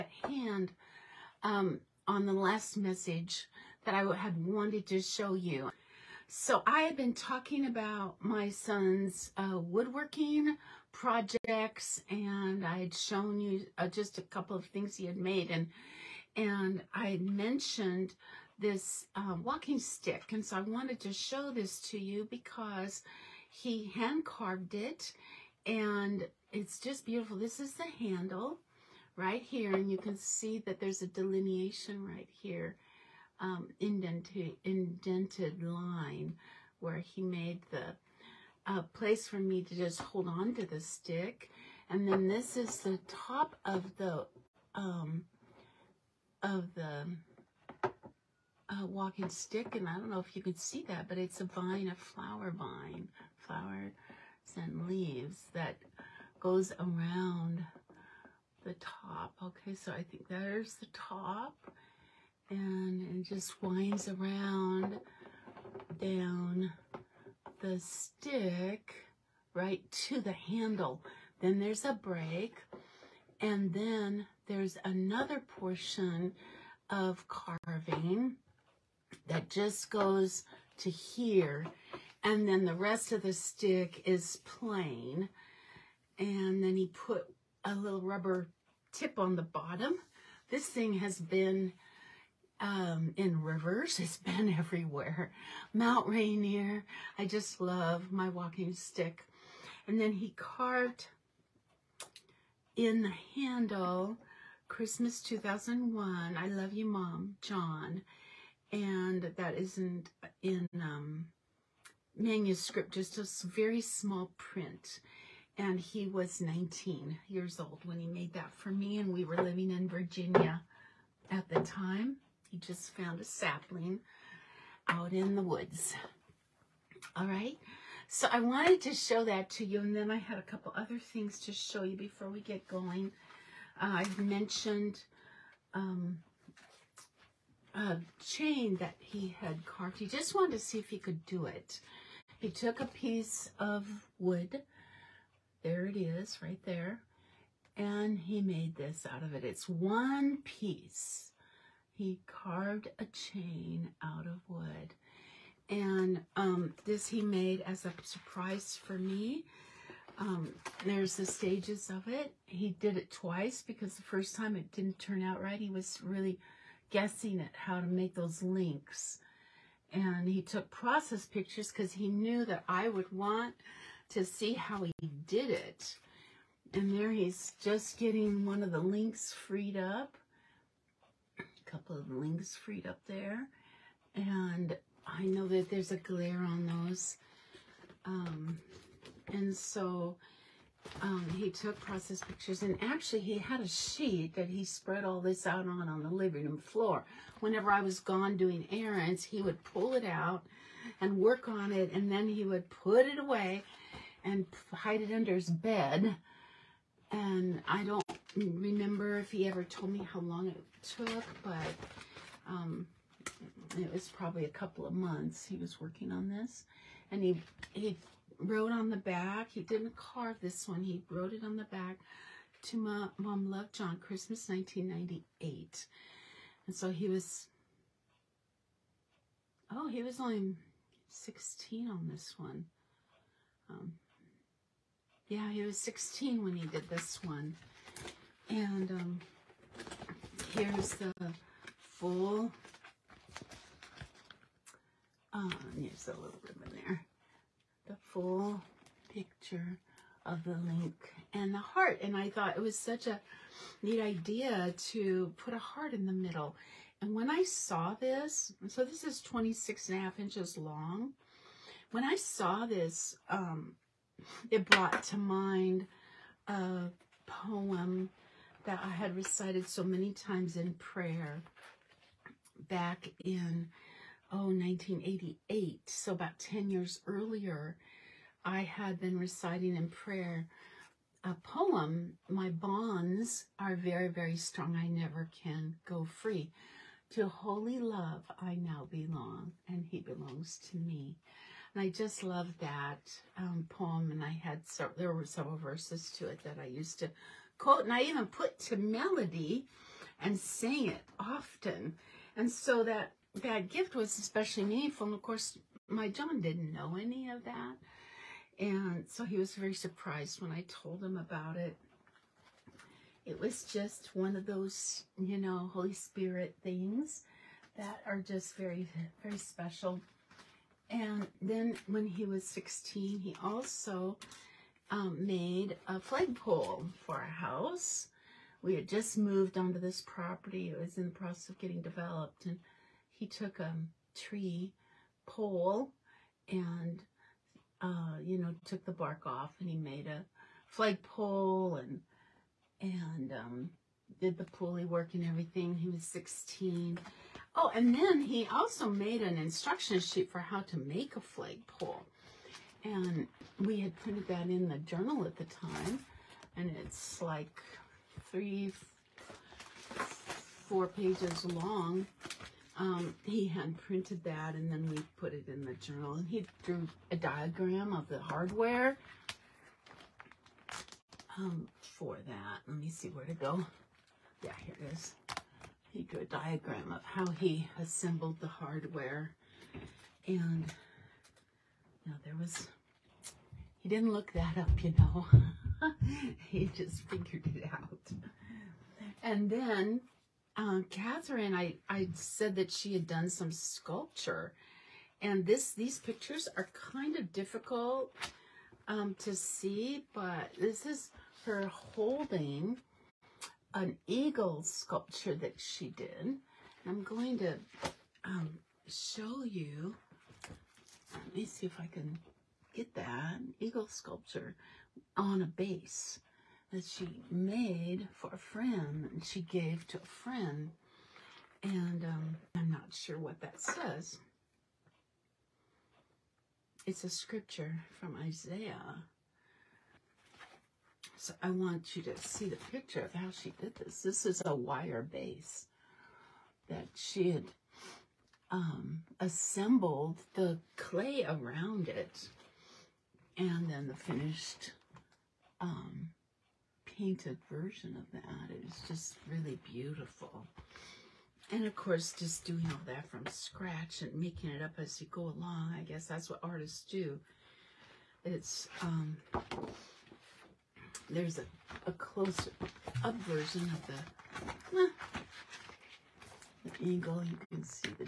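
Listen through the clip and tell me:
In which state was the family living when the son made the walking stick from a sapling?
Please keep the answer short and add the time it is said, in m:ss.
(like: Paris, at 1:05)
Virginia, at 1:59.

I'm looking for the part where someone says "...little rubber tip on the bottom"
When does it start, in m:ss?
1:27.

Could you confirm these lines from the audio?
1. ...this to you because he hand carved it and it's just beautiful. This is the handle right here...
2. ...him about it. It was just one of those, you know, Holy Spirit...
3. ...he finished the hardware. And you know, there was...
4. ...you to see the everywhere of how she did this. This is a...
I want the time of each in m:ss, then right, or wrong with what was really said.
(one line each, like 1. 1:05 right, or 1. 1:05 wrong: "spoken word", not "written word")
1. 0:21 right
2. 5:11 right
3. 6:17 wrong: "assembled", not "finished"
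4. 7:11 wrong: "picture", not "everywhere".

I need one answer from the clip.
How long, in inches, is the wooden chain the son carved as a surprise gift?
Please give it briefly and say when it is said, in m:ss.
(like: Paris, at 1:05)
26.5 inches, at 4:19.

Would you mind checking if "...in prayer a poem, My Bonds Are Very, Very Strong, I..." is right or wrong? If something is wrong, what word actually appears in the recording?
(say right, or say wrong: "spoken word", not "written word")
right.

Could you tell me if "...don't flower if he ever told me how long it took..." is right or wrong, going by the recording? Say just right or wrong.
wrong.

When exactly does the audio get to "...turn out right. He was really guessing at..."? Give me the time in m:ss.
2:44.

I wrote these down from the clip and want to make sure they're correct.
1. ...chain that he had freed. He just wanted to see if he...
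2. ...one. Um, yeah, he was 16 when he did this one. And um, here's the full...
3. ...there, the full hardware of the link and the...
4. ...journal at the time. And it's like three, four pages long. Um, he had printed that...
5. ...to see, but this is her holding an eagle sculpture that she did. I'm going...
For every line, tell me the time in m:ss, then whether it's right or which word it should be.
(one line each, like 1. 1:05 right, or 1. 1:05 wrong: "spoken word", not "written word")
1. 2:18 wrong: "carved", not "freed"
2. 3:52 right
3. 4:06 wrong: "picture", not "hardware"
4. 5:54 right
5. 6:39 right.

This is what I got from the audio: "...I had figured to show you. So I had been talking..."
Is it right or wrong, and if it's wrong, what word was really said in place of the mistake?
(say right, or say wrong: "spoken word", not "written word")
wrong: "wanted", not "figured".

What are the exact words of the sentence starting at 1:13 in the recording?
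And then there's another portion of carving that just goes to here.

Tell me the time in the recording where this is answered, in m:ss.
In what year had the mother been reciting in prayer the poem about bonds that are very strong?
4:34.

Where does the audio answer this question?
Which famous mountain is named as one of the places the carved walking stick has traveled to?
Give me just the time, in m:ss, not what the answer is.
1:35.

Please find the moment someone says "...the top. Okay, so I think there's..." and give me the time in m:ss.
0:58.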